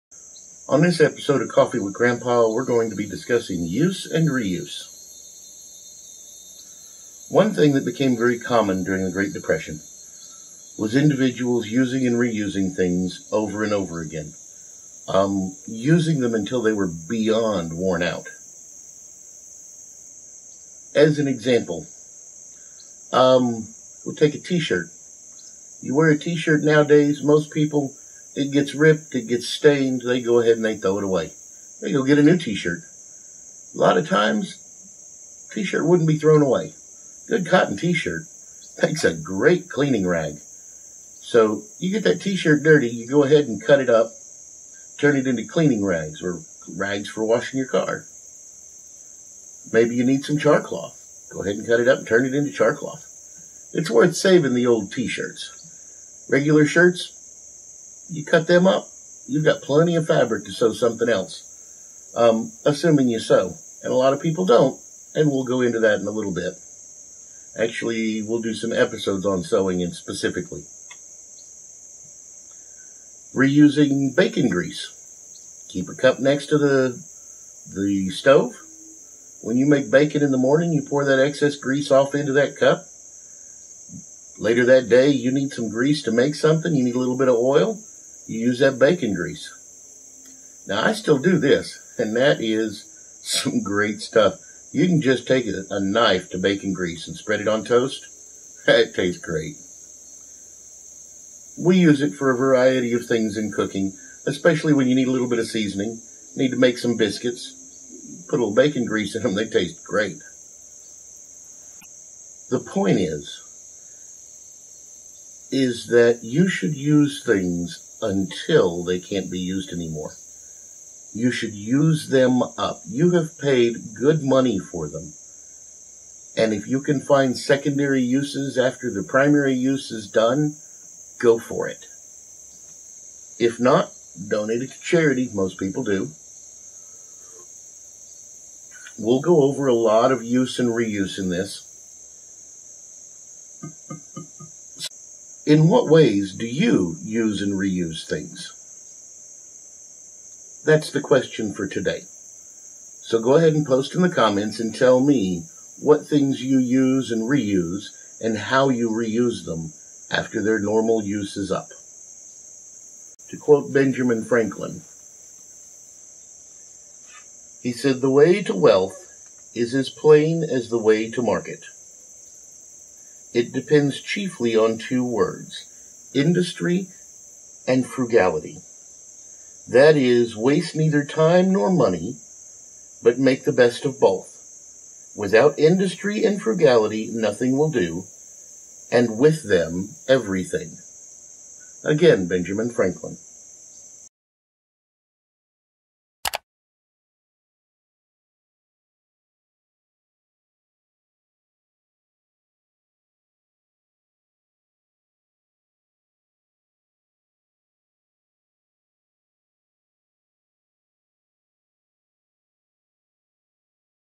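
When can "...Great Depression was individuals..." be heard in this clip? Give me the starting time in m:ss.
0:09.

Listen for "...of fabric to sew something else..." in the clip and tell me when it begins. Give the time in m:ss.
0:59.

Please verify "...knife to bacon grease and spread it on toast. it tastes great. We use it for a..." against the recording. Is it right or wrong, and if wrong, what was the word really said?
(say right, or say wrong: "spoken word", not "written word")
right.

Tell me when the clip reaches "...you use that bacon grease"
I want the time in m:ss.
1:28.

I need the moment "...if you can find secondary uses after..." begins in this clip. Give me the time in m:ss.
2:06.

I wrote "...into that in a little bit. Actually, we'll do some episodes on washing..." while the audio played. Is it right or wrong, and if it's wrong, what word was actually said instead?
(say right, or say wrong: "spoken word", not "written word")
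wrong: "sewing", not "washing".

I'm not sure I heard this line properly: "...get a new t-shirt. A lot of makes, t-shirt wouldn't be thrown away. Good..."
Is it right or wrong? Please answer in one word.
wrong.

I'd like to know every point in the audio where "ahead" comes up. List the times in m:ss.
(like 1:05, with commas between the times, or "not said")
0:30, 0:43, 0:51, 2:33.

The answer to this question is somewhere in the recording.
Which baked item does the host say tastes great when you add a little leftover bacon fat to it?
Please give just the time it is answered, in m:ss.
1:46.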